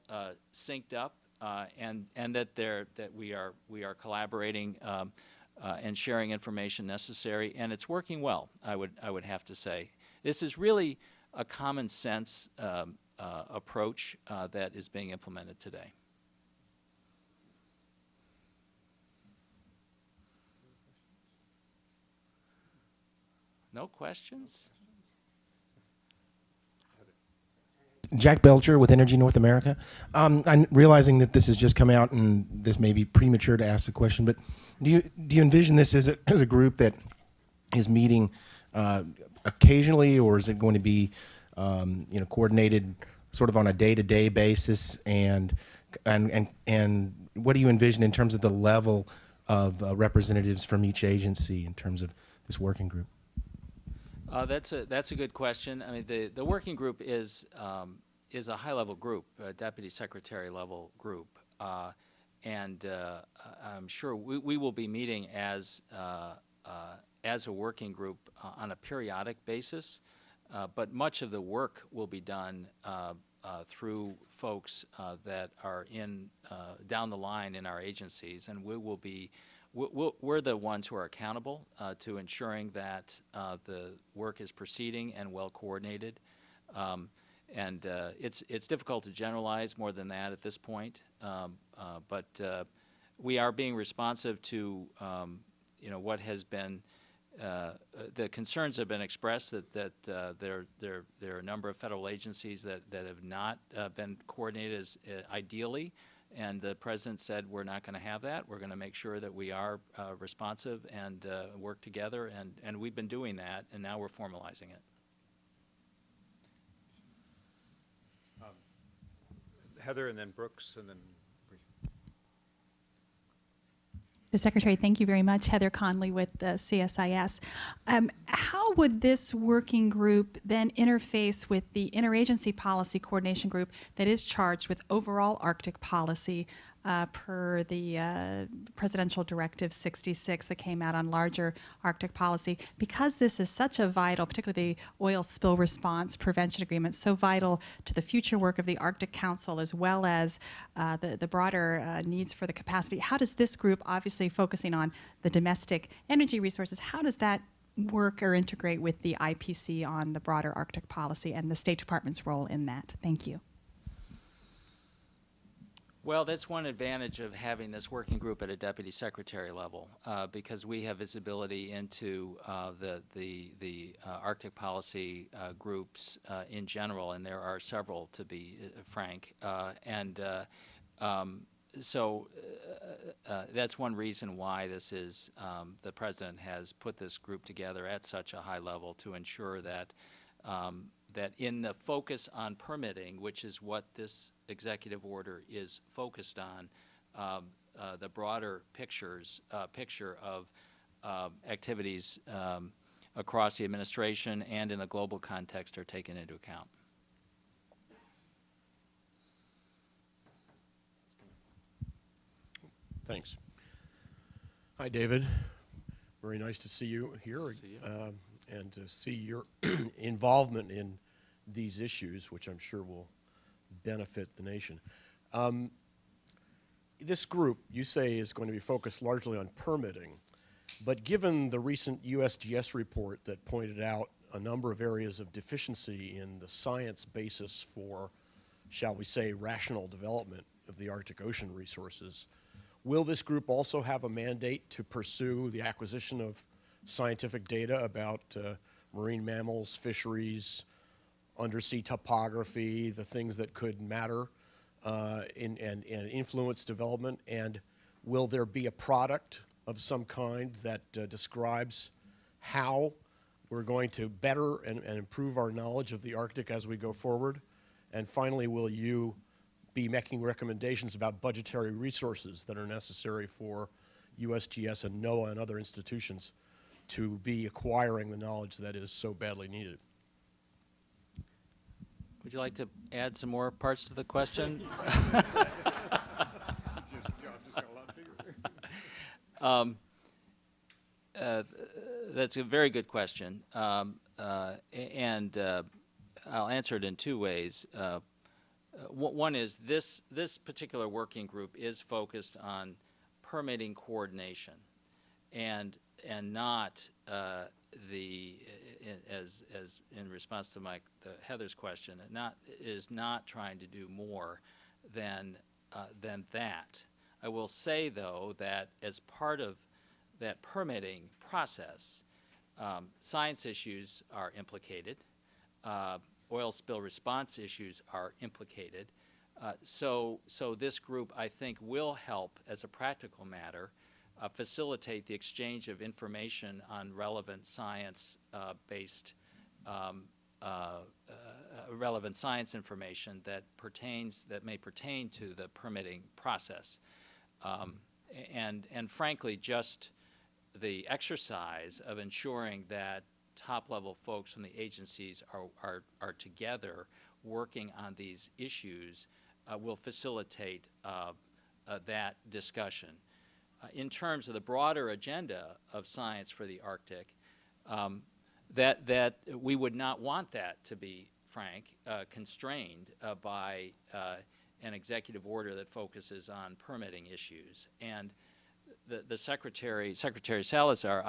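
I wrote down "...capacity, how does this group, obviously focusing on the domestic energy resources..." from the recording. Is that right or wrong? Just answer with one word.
right.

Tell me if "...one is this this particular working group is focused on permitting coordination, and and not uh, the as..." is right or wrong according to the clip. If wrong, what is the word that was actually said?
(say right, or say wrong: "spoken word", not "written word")
right.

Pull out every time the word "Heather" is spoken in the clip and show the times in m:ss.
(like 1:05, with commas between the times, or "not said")
1:59, 2:05, 5:11.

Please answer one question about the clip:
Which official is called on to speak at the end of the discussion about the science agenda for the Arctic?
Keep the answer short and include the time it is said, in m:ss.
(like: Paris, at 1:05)
Secretary Salazar, at 6:19.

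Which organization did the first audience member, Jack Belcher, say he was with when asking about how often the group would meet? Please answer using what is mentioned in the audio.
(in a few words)
Energy North America.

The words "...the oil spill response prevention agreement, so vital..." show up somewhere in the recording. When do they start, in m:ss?
2:24.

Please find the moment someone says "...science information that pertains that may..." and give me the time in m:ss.
5:42.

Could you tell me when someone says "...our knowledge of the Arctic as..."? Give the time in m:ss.
4:25.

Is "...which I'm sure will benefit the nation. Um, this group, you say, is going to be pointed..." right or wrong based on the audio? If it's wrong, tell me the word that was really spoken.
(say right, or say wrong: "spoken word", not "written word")
wrong: "focused", not "pointed".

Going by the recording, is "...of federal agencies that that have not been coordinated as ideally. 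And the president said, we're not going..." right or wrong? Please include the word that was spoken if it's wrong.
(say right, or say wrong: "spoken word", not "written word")
right.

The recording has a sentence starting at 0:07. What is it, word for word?
And it's working well, I would, I would have to say.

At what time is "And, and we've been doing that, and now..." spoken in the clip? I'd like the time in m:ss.
1:52.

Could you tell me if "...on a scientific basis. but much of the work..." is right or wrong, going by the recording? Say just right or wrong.
wrong.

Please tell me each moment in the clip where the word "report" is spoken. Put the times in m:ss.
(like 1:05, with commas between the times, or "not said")
3:52.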